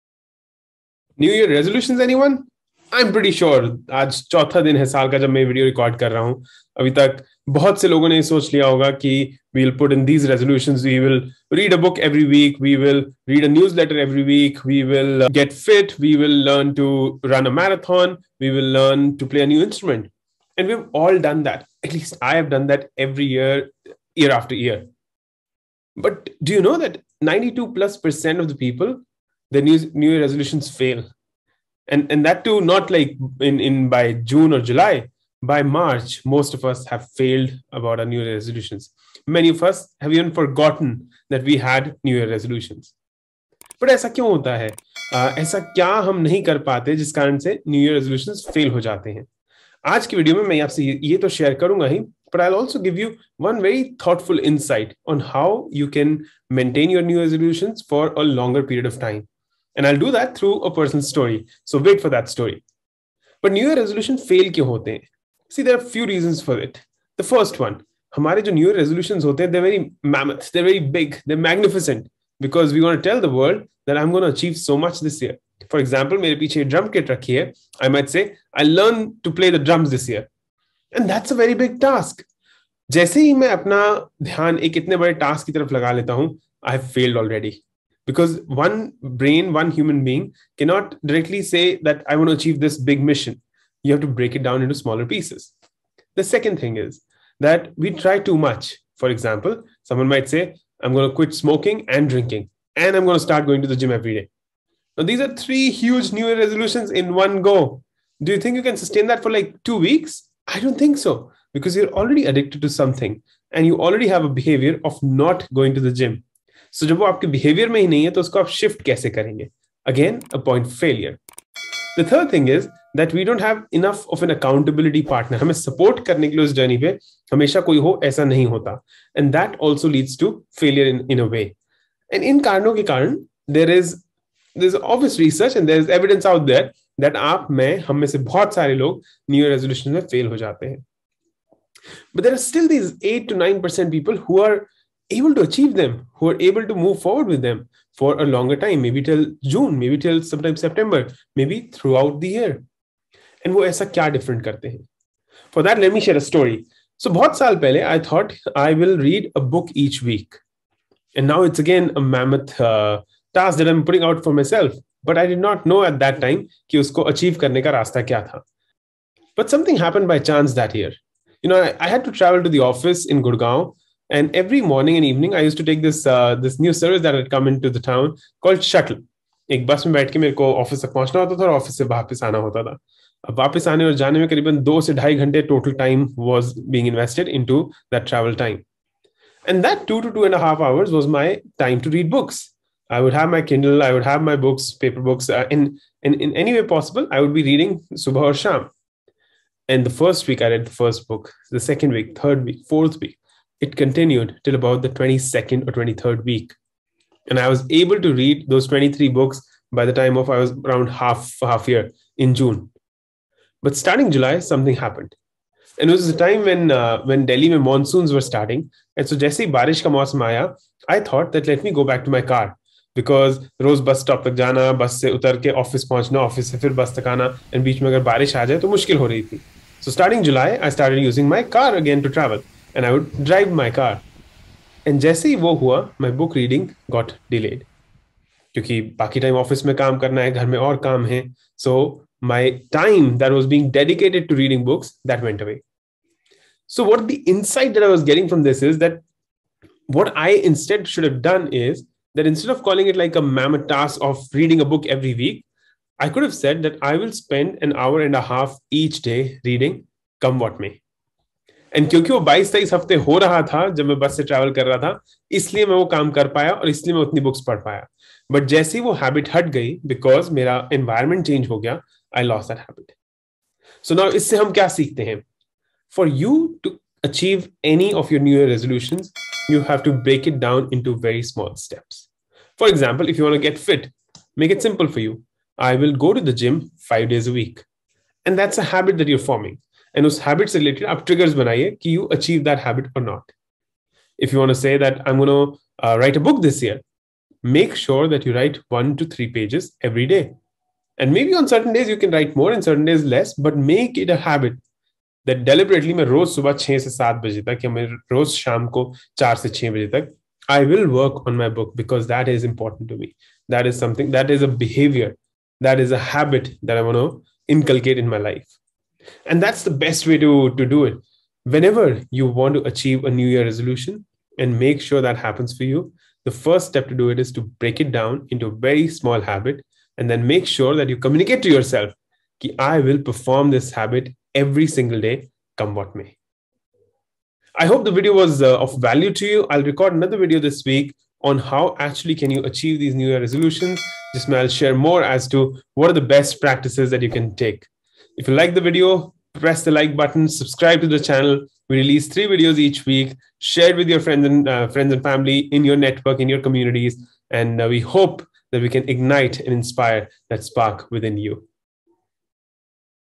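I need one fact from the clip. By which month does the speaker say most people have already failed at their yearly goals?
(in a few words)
March.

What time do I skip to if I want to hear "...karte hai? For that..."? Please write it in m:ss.
2:34.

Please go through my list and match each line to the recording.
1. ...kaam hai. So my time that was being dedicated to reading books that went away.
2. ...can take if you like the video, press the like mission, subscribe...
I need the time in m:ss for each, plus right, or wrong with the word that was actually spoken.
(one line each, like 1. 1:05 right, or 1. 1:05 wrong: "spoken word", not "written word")
1. 4:00 right
2. 5:47 wrong: "button", not "mission".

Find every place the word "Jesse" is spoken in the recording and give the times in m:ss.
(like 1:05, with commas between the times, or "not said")
3:39, 3:54.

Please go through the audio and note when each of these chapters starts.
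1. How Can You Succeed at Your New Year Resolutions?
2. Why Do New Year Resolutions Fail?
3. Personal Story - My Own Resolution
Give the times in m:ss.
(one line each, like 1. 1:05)
1. 4:36
2. 1:05
3. 2:36.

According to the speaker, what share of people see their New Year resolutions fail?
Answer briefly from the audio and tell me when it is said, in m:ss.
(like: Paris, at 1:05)
92+ percent, at 0:27.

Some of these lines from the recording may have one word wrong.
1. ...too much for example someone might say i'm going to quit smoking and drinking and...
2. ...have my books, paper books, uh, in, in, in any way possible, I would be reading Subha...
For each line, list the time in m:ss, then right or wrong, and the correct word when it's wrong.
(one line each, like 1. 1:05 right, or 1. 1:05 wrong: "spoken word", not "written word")
1. 1:38 right
2. 3:14 right.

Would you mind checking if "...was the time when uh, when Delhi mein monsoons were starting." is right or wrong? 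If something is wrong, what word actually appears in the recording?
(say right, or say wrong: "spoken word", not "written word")
right.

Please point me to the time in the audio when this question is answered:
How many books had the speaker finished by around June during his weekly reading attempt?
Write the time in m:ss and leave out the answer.
3:28.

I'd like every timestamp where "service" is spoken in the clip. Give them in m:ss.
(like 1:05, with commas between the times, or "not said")
2:56.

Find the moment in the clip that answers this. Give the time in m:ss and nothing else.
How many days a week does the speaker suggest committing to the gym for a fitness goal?
4:46.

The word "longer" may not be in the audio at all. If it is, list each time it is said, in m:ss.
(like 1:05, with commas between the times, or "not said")
0:58, 2:28.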